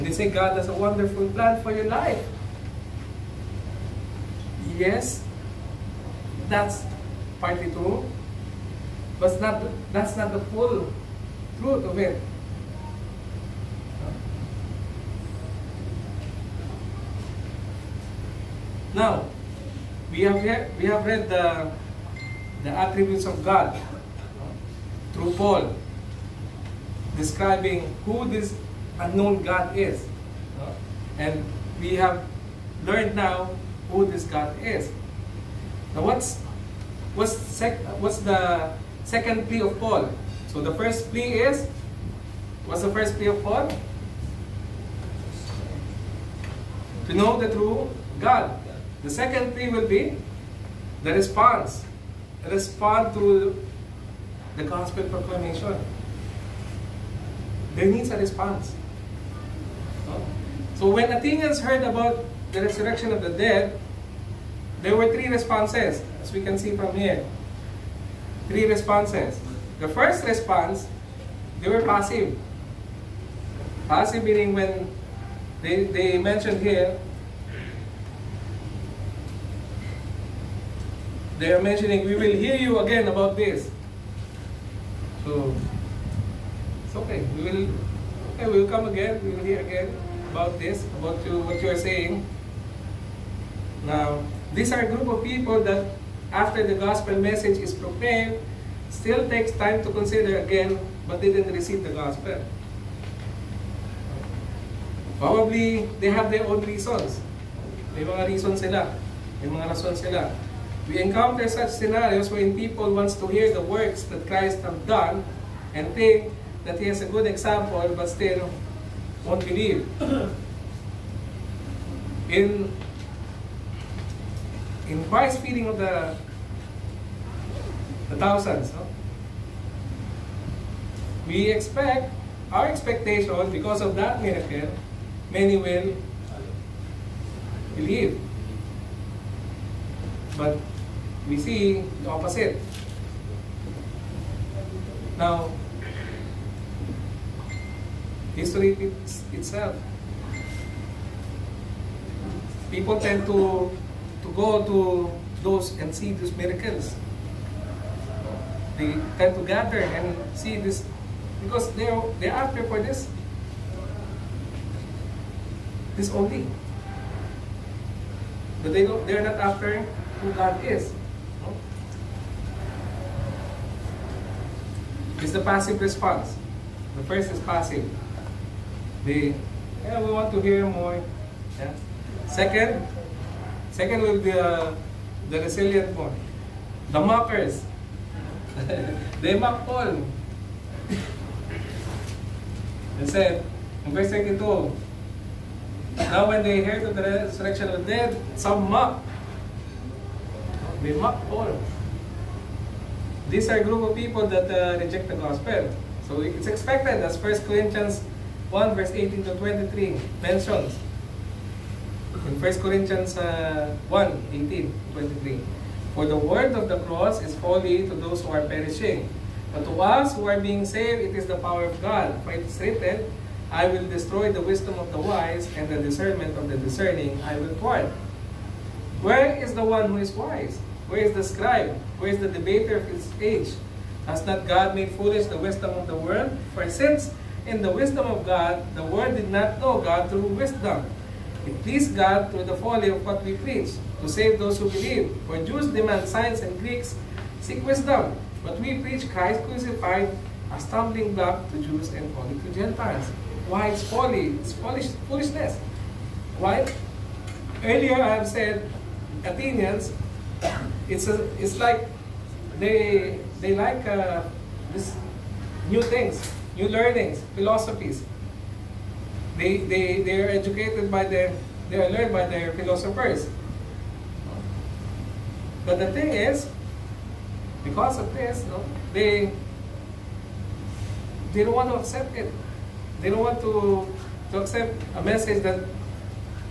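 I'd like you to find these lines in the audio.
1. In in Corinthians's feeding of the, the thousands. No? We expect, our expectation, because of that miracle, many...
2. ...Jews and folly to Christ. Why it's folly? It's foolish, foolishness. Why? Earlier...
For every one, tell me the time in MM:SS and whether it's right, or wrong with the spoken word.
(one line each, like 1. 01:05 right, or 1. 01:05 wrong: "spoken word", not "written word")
1. 02:02 wrong: "Christ", not "Corinthians"
2. 04:11 wrong: "Gentiles", not "Christ".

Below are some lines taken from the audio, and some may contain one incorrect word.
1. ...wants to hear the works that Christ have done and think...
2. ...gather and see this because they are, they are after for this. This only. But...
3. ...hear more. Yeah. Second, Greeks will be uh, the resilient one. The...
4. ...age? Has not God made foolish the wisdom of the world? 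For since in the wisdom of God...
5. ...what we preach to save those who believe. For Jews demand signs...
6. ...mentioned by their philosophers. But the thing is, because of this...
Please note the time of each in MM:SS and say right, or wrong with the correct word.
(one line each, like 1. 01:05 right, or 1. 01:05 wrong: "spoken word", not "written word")
1. 01:52 right
2. 02:39 right
3. 03:00 wrong: "Second", not "Greeks"
4. 03:53 right
5. 04:03 right
6. 04:31 wrong: "learned", not "mentioned".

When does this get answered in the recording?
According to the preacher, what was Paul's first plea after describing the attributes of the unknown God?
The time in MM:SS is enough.
00:47.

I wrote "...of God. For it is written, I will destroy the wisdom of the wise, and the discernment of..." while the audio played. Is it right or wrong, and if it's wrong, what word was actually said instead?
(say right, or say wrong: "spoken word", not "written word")
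right.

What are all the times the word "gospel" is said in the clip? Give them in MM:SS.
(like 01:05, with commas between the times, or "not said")
00:54, 01:36, 01:41, 03:25.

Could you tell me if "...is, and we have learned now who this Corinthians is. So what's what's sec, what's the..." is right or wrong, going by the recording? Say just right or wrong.
wrong.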